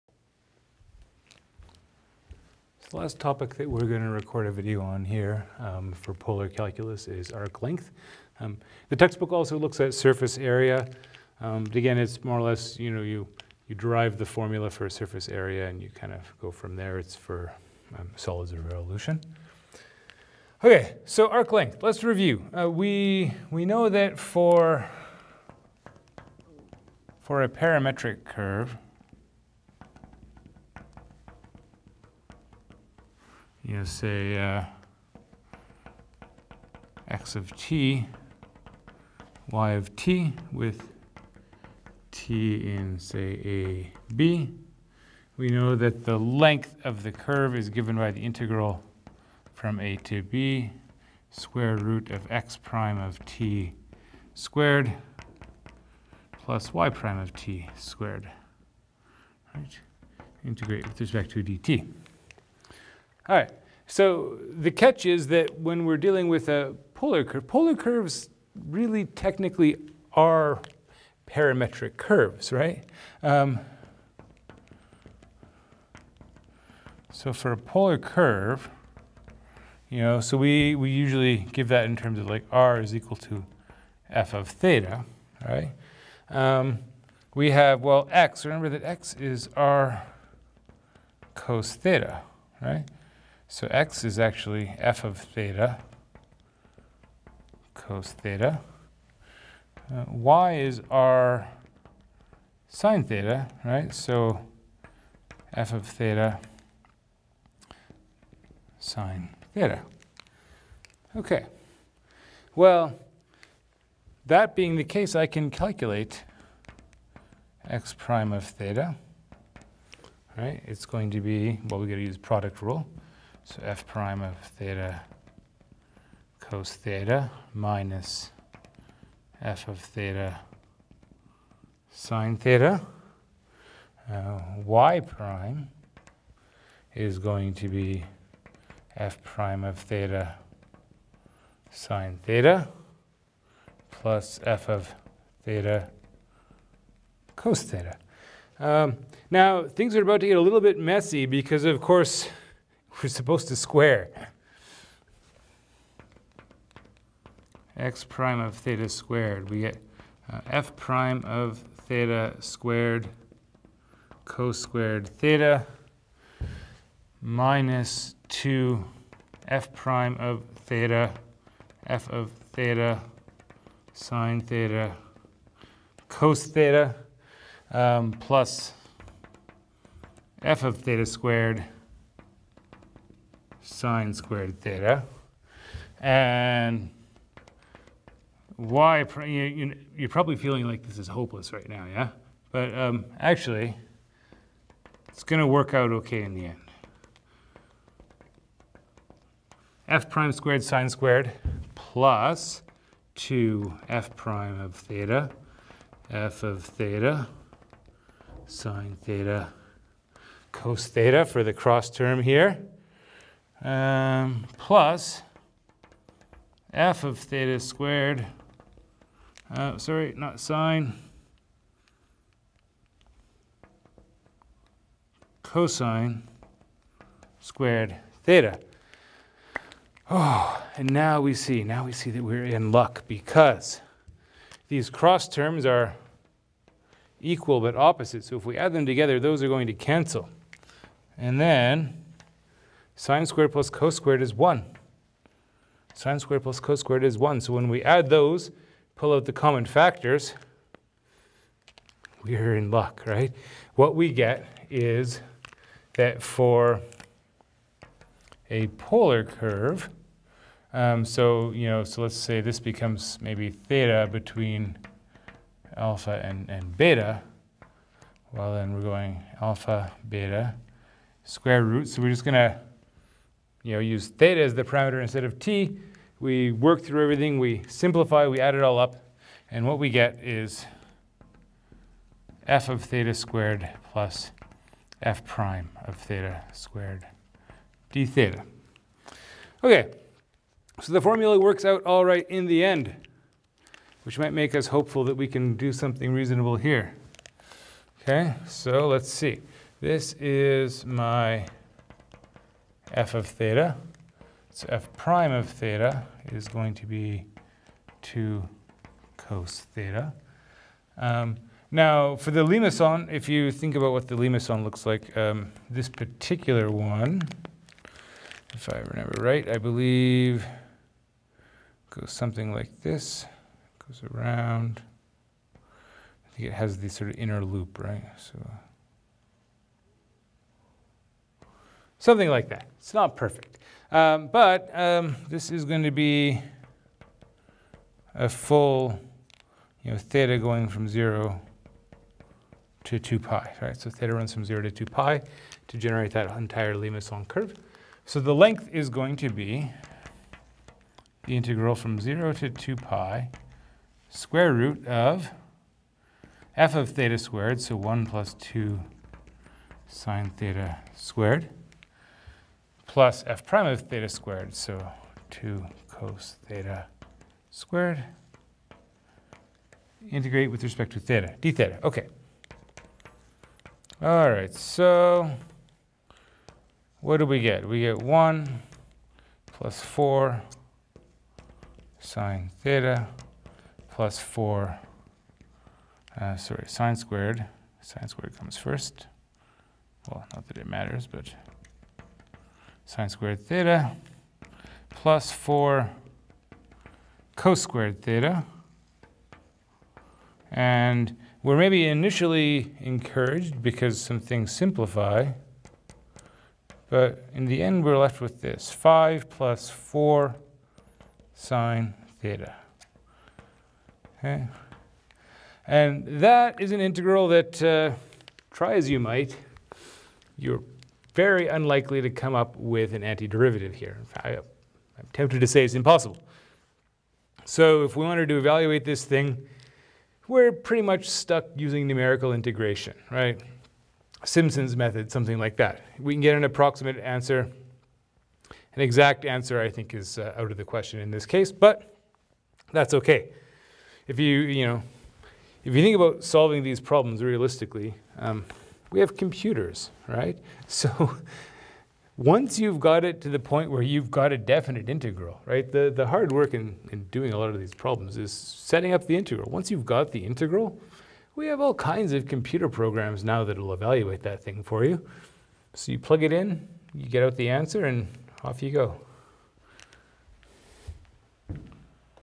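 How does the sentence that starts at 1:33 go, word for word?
So x is actually f of theta cos theta.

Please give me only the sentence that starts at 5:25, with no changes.
I think it has the sort of inner loop, right?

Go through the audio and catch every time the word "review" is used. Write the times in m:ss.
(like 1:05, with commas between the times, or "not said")
0:22.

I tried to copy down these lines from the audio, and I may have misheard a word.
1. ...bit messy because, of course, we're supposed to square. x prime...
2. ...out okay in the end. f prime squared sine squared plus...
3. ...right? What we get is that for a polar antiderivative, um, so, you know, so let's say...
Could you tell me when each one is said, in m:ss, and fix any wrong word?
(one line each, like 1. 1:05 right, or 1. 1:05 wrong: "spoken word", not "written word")
1. 2:30 right
2. 3:15 right
3. 4:13 wrong: "curve", not "antiderivative".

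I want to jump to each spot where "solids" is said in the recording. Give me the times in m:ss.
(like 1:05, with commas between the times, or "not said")
0:18.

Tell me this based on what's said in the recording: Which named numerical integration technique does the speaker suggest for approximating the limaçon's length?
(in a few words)
Simpson's method.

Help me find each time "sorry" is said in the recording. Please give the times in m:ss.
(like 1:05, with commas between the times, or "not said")
3:39, 6:26.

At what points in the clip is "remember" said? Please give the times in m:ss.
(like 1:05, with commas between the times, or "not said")
1:28, 5:18.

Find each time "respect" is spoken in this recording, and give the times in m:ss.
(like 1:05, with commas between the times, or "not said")
1:00, 6:10.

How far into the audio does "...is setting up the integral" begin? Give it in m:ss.
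7:38.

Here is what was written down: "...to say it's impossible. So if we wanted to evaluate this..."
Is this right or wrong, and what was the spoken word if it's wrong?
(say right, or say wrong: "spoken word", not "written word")
right.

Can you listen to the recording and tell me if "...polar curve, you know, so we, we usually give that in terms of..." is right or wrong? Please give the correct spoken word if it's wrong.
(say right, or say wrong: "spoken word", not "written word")
right.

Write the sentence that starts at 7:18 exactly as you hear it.
An exact answer, I think, is uh, out of the question in this case, but that's okay.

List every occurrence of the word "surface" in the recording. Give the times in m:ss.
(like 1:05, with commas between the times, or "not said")
0:09, 0:14.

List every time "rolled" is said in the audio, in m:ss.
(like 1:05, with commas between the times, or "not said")
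not said.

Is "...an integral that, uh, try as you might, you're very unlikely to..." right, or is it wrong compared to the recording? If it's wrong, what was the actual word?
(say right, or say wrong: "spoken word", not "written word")
right.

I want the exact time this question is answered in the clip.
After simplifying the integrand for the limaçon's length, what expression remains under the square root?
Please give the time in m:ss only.
6:48.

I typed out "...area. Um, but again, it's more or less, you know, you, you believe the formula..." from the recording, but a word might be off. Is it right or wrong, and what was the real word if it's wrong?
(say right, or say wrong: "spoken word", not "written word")
wrong: "derive", not "believe".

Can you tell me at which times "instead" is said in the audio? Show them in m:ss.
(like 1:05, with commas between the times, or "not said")
4:35.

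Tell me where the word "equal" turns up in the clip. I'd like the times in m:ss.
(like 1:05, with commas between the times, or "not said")
1:22, 3:57.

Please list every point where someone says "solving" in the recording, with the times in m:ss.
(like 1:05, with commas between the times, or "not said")
7:26.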